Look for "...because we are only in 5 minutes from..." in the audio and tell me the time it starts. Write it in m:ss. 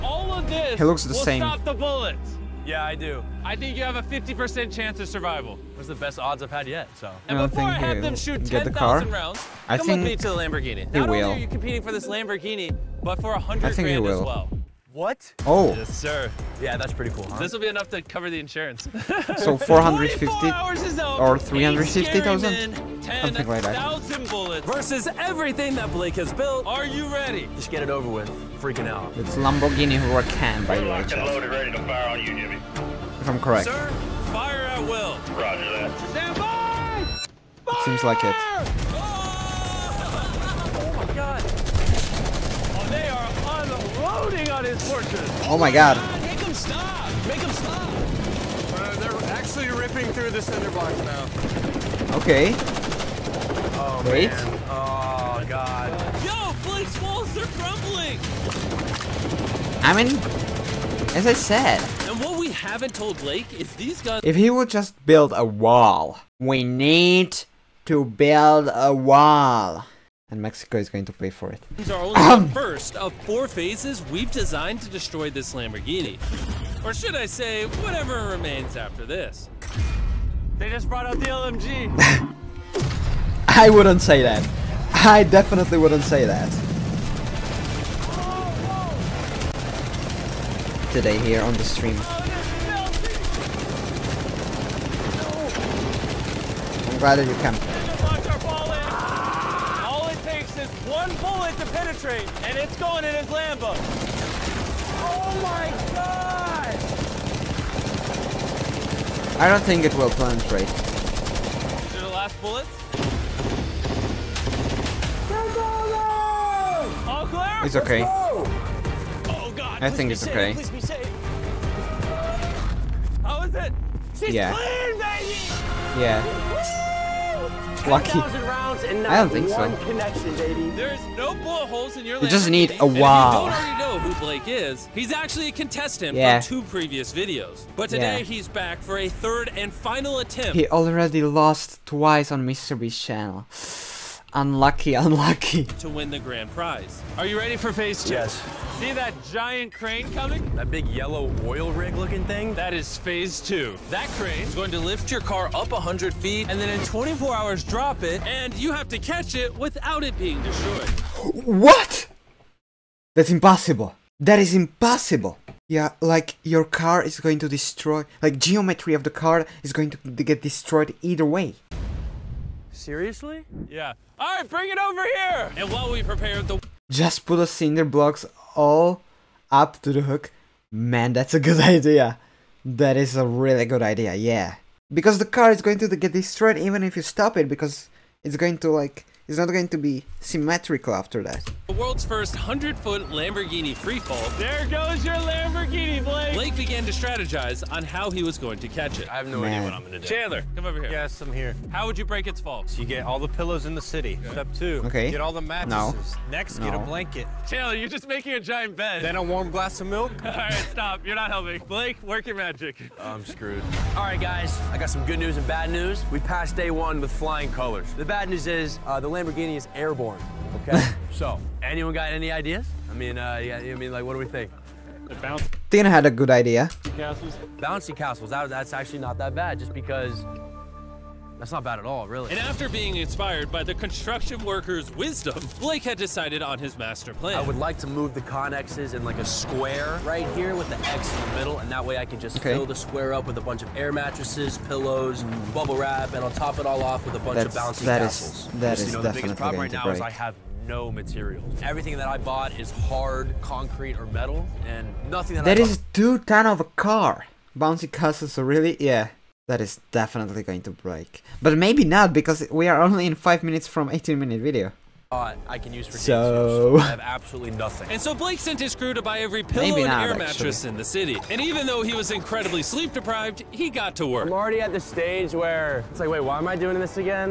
4:22.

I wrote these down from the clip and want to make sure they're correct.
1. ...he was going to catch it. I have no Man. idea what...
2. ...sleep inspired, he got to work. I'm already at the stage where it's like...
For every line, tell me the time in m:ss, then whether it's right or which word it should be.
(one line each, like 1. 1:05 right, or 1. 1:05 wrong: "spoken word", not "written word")
1. 3:18 right
2. 4:32 wrong: "deprived", not "inspired".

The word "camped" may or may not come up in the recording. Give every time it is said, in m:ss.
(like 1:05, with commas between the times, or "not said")
1:37.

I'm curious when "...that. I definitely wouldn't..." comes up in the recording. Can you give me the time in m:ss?
1:24.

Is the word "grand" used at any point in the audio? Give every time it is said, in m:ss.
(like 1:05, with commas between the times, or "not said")
0:13, 2:26.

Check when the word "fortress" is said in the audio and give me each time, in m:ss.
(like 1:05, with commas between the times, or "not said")
0:44.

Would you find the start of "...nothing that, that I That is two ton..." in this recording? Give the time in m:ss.
4:15.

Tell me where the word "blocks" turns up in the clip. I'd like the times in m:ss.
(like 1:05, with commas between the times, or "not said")
0:50, 2:57.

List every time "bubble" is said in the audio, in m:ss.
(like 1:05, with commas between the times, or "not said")
4:05.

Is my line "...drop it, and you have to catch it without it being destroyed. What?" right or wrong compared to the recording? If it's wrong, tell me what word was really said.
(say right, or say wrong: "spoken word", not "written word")
right.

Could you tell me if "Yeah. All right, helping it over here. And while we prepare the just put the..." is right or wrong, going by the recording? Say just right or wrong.
wrong.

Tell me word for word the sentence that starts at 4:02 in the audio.
fill the square up with a bunch of air mattresses, pillows, mm.